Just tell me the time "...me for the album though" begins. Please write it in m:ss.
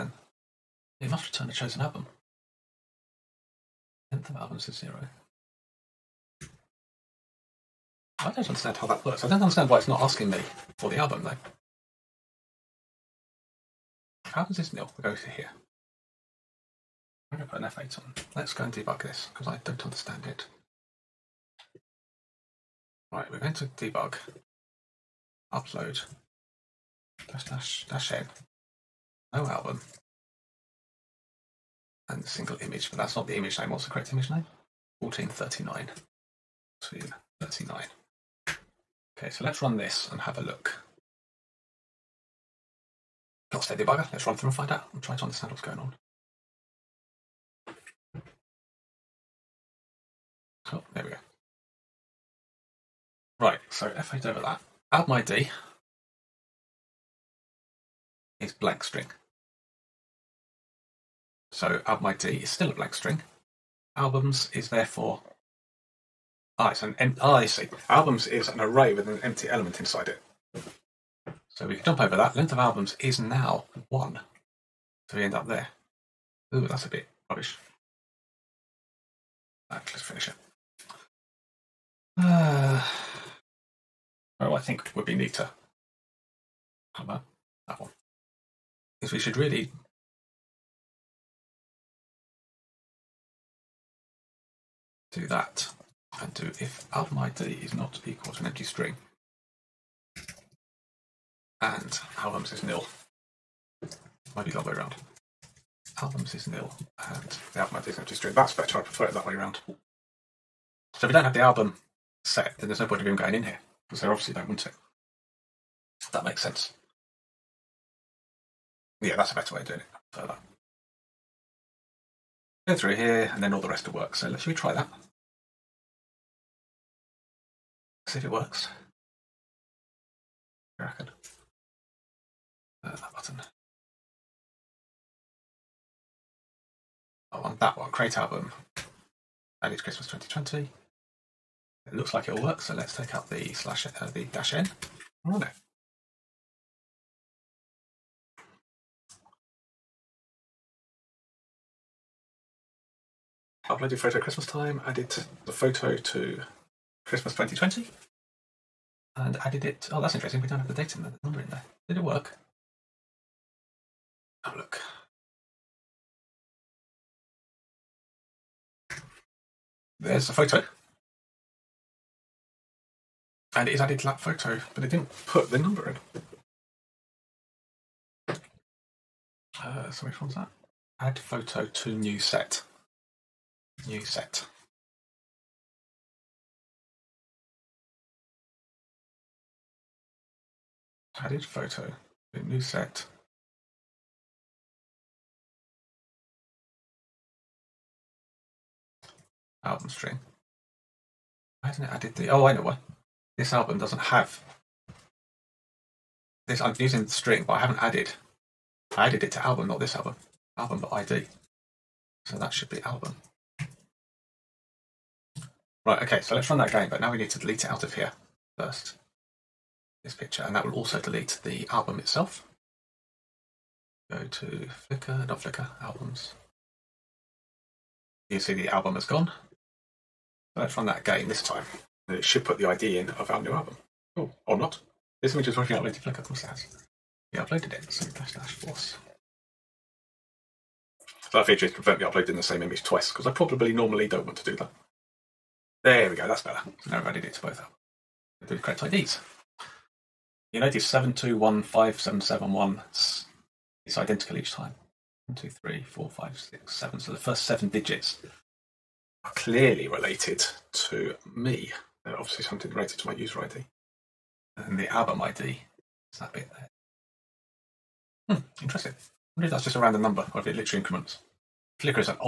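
0:10.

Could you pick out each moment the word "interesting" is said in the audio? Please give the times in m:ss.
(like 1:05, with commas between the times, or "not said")
2:40, 4:28.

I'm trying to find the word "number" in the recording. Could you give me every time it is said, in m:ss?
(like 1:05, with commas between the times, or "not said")
2:41, 2:55, 4:30.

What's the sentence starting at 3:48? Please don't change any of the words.
You see the album has gone.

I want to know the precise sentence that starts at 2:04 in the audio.
So let, should we try that?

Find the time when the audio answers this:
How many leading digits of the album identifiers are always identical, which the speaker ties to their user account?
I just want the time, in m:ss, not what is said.
4:17.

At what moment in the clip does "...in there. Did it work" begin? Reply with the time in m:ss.
2:41.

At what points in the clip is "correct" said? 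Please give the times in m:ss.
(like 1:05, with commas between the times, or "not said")
0:33, 4:08.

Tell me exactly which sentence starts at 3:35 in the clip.
Right, okay, so let's run that again, but now we need to delete it out of here first.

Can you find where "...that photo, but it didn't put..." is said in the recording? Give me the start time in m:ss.
2:54.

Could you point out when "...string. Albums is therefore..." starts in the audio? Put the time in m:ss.
1:02.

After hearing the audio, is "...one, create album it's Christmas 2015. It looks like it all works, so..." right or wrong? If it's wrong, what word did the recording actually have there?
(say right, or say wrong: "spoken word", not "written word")
wrong: "2020", not "2015".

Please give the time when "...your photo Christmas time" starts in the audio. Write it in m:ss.
2:33.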